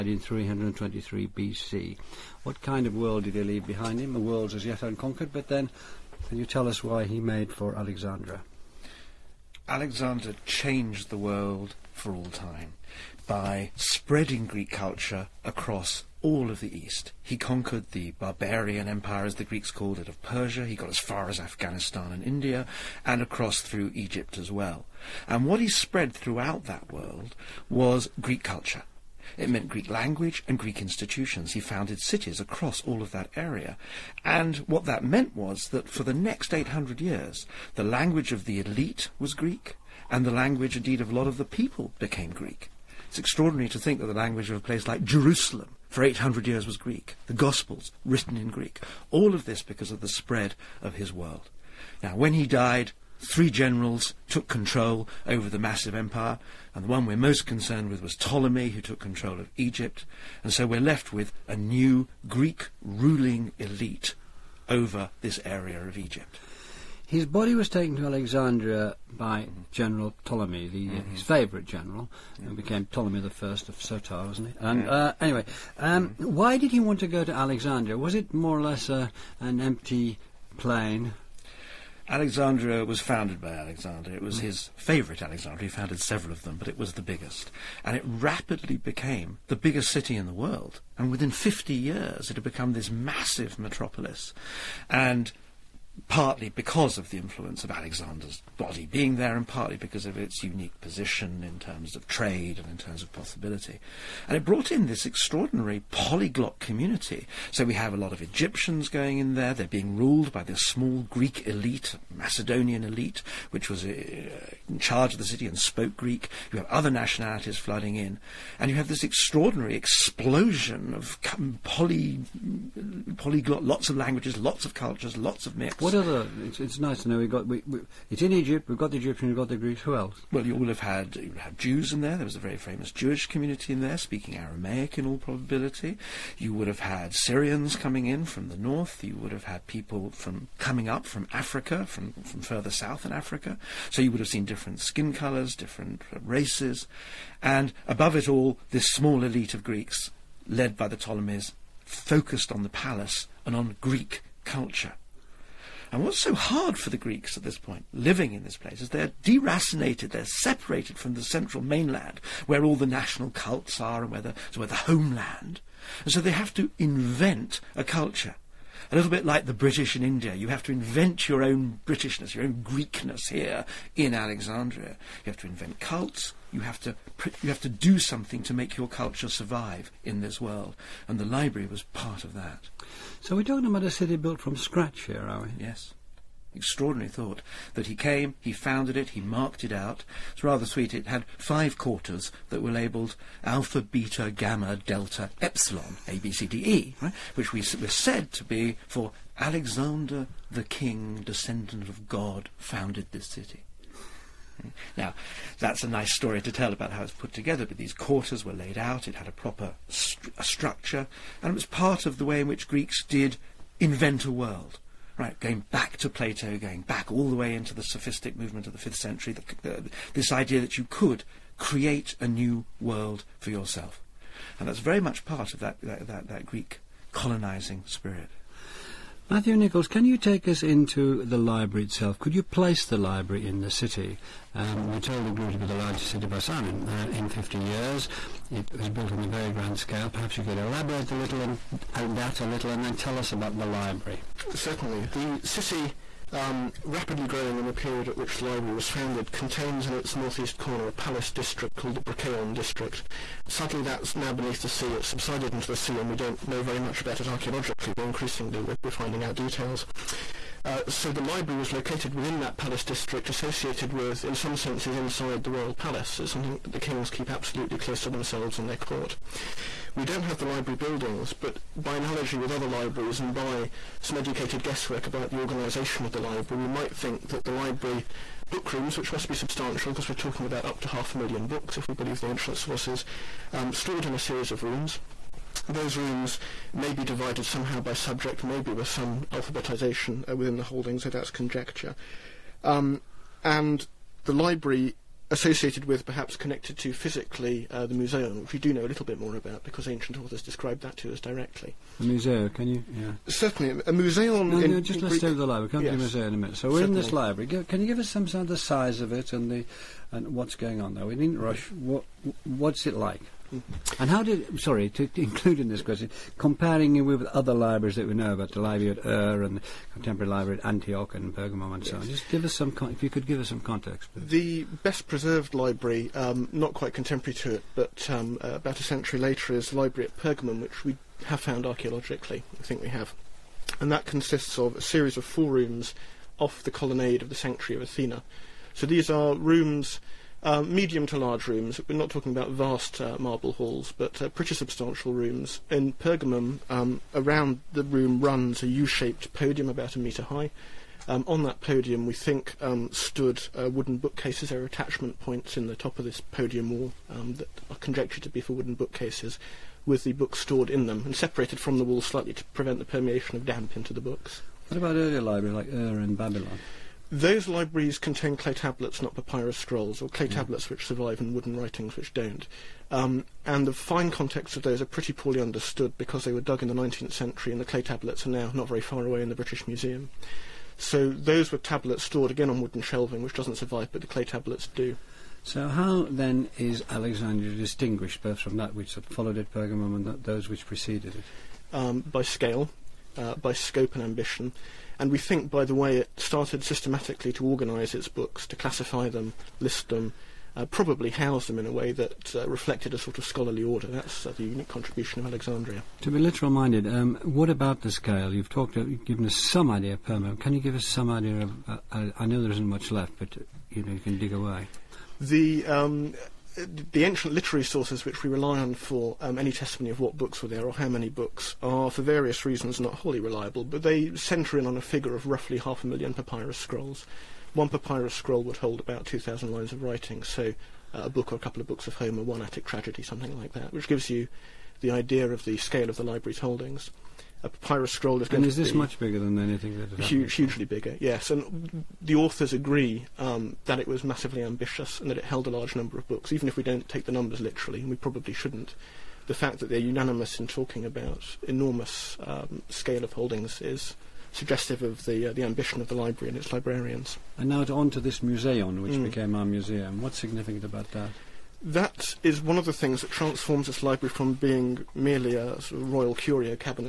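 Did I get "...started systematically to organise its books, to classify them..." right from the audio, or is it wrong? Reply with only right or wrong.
right.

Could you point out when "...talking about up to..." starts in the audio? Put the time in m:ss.
4:40.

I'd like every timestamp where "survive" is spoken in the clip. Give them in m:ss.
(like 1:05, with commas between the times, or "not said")
2:59, 6:10, 6:23.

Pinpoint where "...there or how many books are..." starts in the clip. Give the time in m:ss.
7:00.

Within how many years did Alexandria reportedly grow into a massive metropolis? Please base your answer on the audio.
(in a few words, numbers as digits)
50.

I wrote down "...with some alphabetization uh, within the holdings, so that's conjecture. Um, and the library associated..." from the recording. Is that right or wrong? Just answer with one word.
right.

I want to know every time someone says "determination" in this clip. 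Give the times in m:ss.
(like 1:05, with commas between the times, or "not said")
not said.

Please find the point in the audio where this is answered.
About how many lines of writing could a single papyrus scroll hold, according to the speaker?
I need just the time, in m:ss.
7:09.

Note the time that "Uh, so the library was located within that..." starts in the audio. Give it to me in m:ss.
4:20.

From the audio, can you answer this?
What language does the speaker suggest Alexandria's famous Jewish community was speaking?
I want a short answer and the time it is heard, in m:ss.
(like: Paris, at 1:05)
Aramaic, at 2:14.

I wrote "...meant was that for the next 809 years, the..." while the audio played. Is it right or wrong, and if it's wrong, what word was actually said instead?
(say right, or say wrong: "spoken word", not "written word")
wrong: "800", not "809".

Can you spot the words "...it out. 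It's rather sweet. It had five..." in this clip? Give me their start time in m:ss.
3:09.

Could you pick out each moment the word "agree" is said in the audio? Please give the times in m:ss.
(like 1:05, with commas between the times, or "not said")
7:22.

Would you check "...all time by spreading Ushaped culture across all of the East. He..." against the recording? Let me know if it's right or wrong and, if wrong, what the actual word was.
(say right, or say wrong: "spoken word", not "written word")
wrong: "Greek", not "Ushaped".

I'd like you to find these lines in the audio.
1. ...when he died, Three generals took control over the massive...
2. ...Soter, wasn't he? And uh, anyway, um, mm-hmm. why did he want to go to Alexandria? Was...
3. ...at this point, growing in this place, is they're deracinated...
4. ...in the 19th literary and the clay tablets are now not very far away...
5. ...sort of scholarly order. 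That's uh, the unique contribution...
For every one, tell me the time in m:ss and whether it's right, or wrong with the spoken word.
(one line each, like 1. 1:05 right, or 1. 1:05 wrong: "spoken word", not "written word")
1. 0:52 right
2. 1:13 right
3. 2:37 wrong: "living", not "growing"
4. 6:16 wrong: "century", not "literary"
5. 6:42 right.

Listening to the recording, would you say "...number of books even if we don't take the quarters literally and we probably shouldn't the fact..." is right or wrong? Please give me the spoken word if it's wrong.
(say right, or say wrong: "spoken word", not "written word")
wrong: "numbers", not "quarters".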